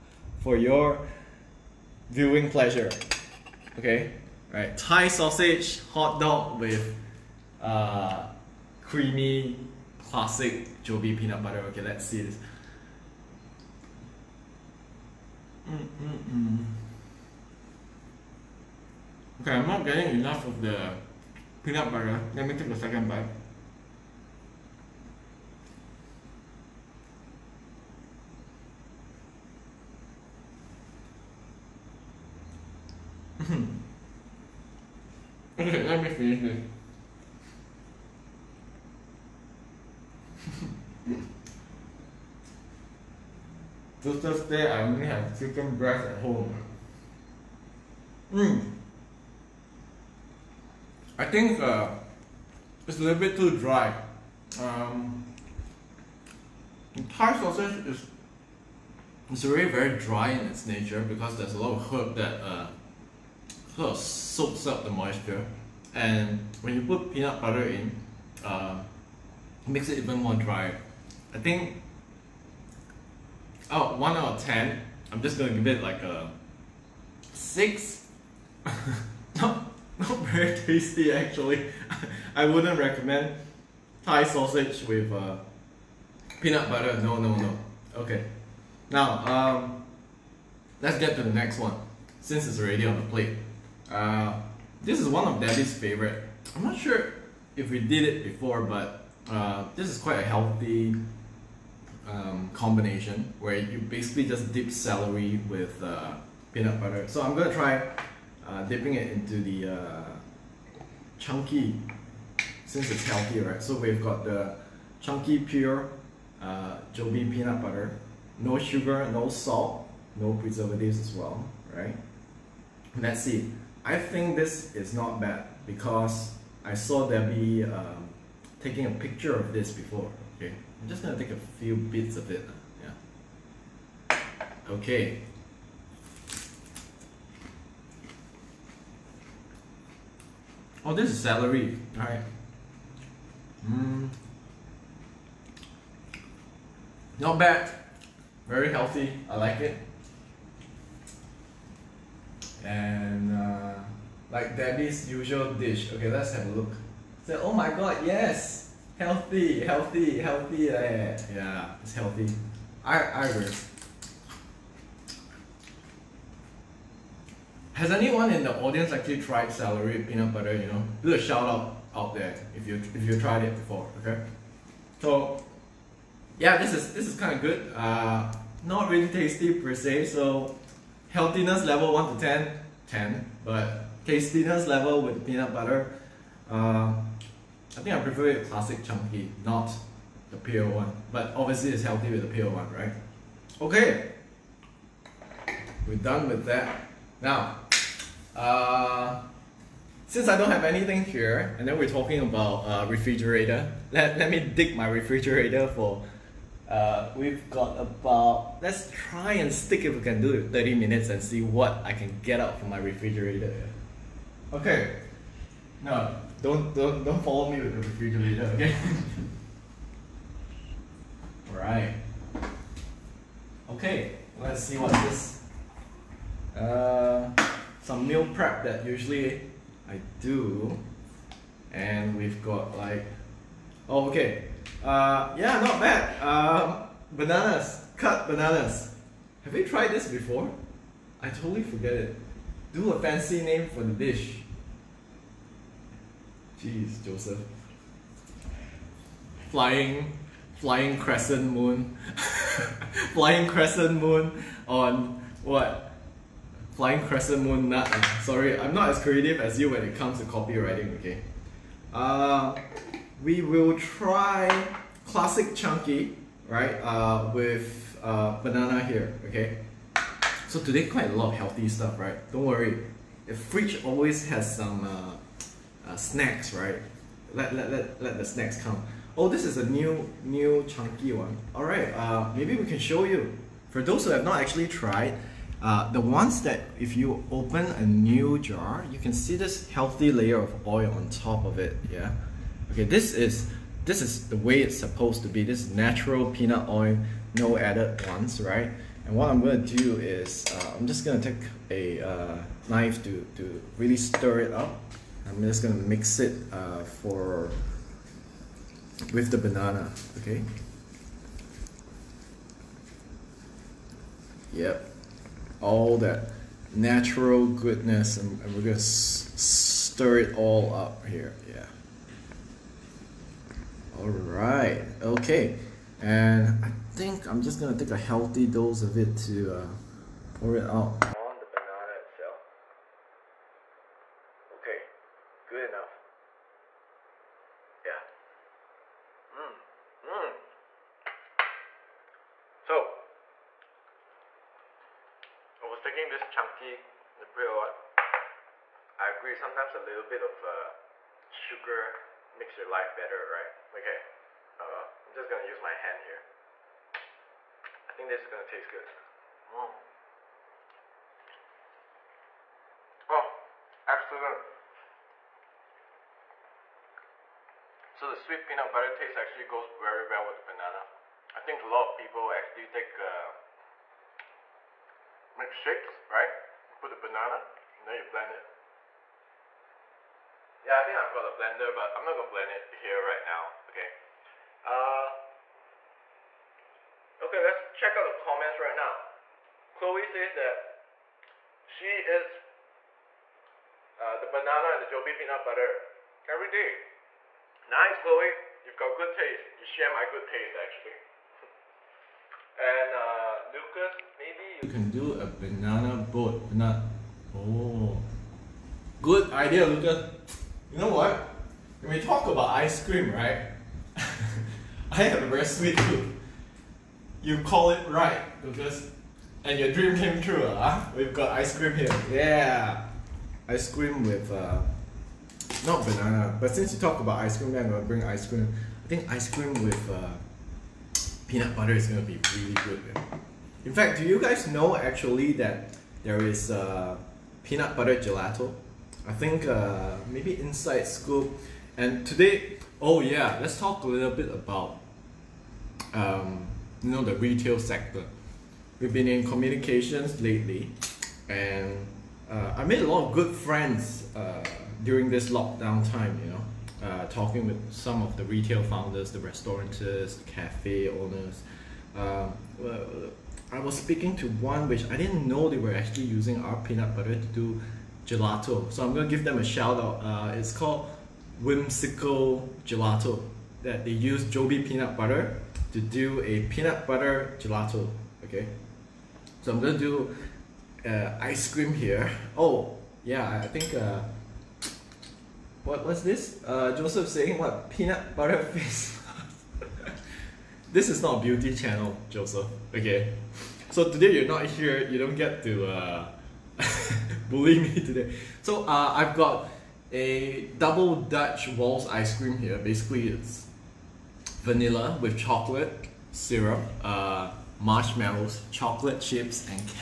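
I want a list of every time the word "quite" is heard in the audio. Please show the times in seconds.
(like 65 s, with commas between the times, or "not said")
99 s, 270 s.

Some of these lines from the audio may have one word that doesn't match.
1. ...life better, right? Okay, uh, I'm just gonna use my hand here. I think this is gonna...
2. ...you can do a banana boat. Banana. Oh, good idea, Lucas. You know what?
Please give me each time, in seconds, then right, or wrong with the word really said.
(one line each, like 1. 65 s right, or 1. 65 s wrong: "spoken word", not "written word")
1. 352 s right
2. 404 s right.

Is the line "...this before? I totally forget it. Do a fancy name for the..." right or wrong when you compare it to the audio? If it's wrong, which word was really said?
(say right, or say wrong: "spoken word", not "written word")
right.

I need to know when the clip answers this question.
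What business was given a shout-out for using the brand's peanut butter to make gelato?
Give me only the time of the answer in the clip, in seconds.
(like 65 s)
471 s.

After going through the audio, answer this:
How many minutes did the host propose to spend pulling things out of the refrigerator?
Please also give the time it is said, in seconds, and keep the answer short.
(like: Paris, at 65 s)
30, at 210 s.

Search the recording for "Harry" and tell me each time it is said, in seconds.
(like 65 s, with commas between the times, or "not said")
not said.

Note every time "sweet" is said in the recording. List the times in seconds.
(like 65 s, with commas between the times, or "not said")
368 s, 415 s.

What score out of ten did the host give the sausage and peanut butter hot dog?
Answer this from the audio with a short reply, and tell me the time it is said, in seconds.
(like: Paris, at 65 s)
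6, at 77 s.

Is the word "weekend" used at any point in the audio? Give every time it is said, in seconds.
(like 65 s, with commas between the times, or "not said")
not said.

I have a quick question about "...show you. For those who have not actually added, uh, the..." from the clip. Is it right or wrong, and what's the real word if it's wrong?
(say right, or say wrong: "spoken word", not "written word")
wrong: "tried", not "added".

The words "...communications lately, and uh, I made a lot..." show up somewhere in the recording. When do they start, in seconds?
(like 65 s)
449 s.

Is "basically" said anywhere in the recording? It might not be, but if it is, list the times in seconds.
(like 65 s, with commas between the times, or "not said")
103 s, 502 s.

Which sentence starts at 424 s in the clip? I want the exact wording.
Uh, not banana, but since you talk about ice cream, I'm gonna bring ice cream.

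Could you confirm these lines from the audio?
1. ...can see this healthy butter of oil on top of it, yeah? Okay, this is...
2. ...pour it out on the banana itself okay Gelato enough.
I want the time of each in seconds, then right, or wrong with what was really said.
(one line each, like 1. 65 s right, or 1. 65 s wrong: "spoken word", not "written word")
1. 288 s wrong: "layer", not "butter"
2. 330 s wrong: "Good", not "Gelato".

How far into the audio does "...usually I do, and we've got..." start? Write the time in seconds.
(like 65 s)
228 s.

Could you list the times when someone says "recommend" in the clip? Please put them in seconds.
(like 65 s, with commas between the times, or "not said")
82 s.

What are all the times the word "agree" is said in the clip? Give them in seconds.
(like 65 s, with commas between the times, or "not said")
163 s, 349 s.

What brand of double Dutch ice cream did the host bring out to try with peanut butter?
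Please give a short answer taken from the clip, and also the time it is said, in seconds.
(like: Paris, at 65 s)
Wall's, at 501 s.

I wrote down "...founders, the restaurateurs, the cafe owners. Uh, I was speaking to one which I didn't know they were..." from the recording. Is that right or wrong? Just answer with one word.
right.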